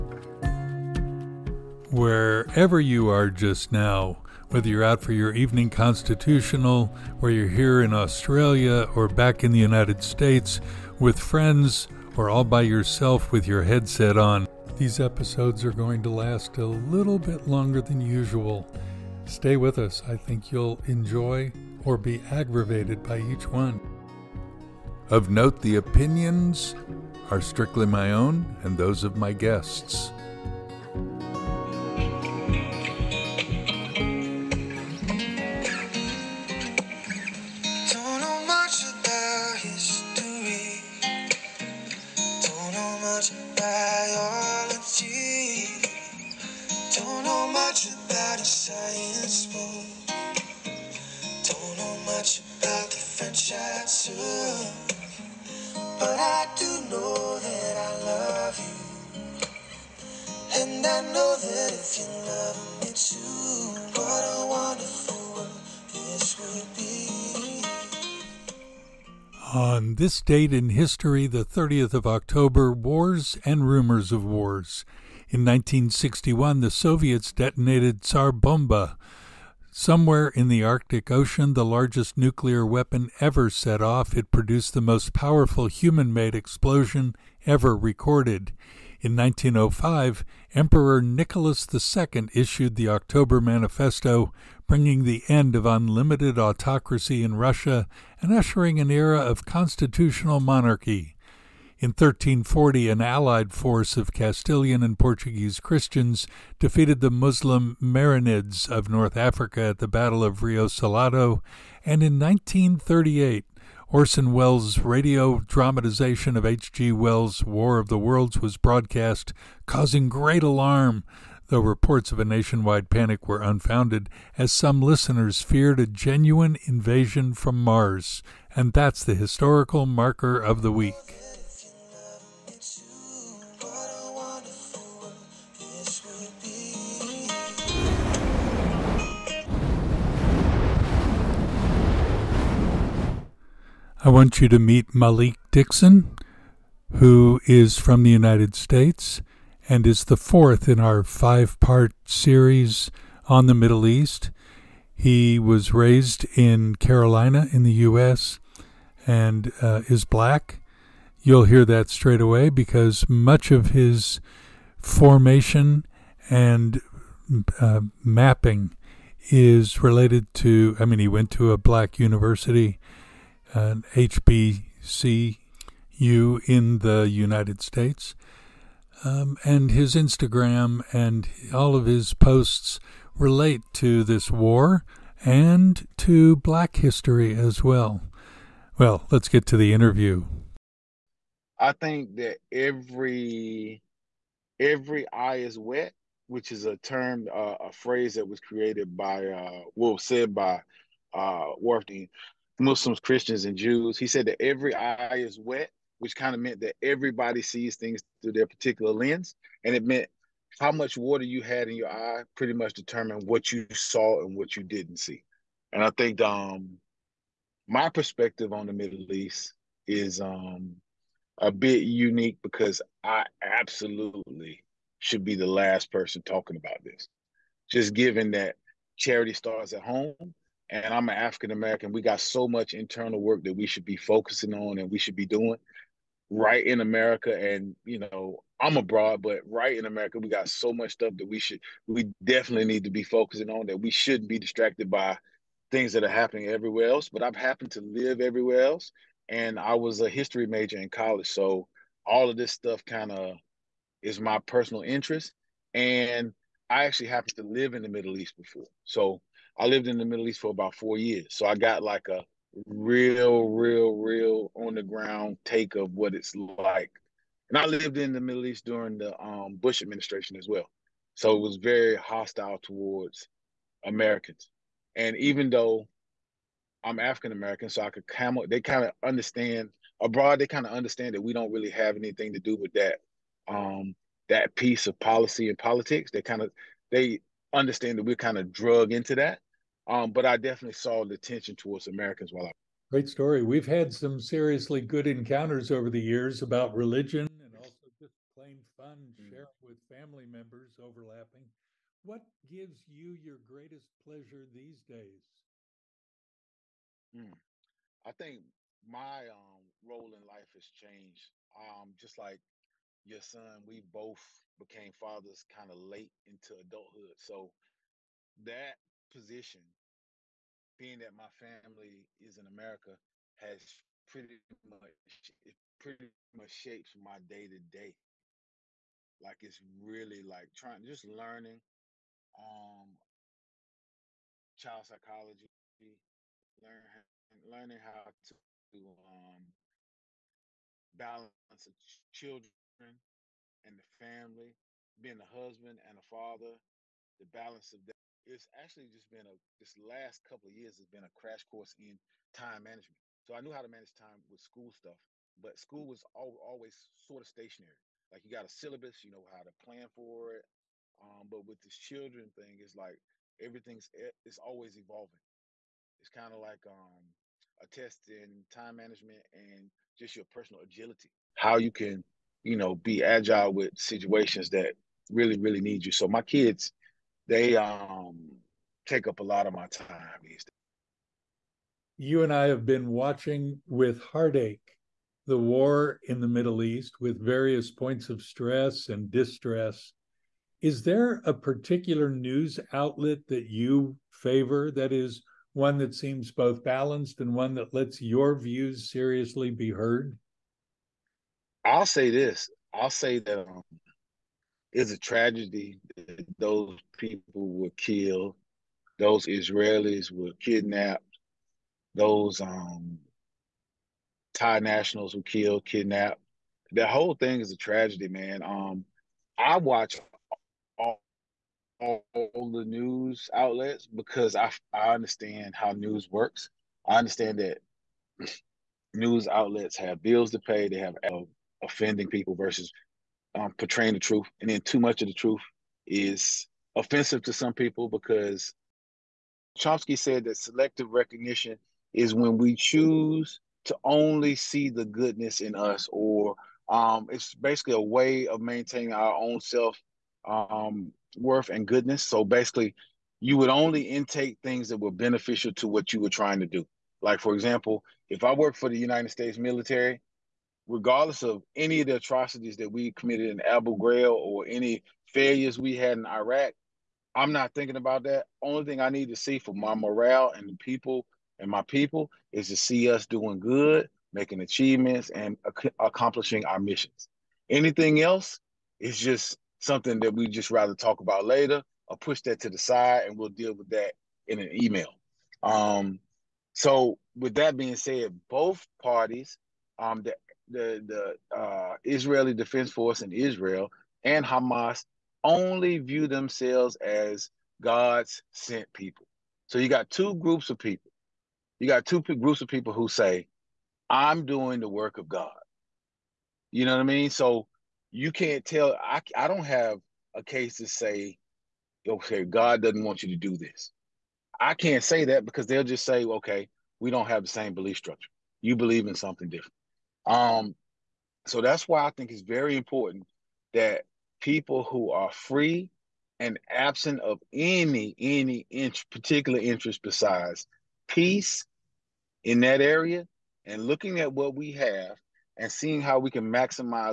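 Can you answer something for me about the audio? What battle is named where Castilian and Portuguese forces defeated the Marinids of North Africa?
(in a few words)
Battle of Rio Salado.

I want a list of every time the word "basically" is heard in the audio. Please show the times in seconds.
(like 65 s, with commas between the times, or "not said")
447 s, 452 s.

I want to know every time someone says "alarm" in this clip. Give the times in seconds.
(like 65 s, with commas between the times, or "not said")
120 s.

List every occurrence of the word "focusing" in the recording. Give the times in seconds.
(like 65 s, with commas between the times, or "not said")
233 s, 243 s.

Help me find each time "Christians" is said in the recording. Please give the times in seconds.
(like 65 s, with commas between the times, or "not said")
105 s, 202 s.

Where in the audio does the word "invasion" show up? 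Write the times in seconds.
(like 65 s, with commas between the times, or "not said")
126 s.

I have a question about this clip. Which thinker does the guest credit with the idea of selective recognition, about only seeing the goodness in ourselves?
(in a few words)
Chomsky.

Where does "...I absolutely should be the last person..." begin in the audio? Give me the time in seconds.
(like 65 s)
223 s.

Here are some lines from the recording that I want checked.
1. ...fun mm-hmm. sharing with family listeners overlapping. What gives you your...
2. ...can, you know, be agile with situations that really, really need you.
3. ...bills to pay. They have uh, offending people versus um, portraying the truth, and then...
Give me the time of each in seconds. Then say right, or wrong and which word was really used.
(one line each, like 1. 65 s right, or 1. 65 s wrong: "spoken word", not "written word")
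1. 298 s wrong: "members", not "listeners"
2. 371 s right
3. 430 s right.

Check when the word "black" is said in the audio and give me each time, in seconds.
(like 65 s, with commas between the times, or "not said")
160 s, 171 s, 186 s.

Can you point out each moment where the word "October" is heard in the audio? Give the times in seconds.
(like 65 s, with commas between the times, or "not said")
72 s, 92 s.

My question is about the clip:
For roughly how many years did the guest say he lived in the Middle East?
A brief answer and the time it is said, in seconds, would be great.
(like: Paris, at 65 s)
4 years, at 260 s.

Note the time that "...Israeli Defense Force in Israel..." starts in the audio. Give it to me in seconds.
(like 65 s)
491 s.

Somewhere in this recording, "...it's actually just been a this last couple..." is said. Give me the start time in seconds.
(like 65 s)
348 s.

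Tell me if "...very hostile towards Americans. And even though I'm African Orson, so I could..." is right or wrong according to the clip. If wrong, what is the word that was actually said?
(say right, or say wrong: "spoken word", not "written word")
wrong: "American", not "Orson".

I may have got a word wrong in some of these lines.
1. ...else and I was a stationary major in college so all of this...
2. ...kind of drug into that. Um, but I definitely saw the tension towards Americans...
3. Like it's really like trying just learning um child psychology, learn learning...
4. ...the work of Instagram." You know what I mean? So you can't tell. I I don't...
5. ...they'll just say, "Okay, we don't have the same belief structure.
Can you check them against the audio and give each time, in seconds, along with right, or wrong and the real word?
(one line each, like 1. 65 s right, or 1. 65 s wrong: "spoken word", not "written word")
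1. 248 s wrong: "history", not "stationary"
2. 288 s right
3. 329 s right
4. 504 s wrong: "God", not "Instagram"
5. 515 s right.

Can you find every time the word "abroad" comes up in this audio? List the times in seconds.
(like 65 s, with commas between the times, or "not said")
238 s, 280 s.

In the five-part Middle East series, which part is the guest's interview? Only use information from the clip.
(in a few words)
fourth.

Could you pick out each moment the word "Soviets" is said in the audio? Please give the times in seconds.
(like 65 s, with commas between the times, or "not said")
76 s.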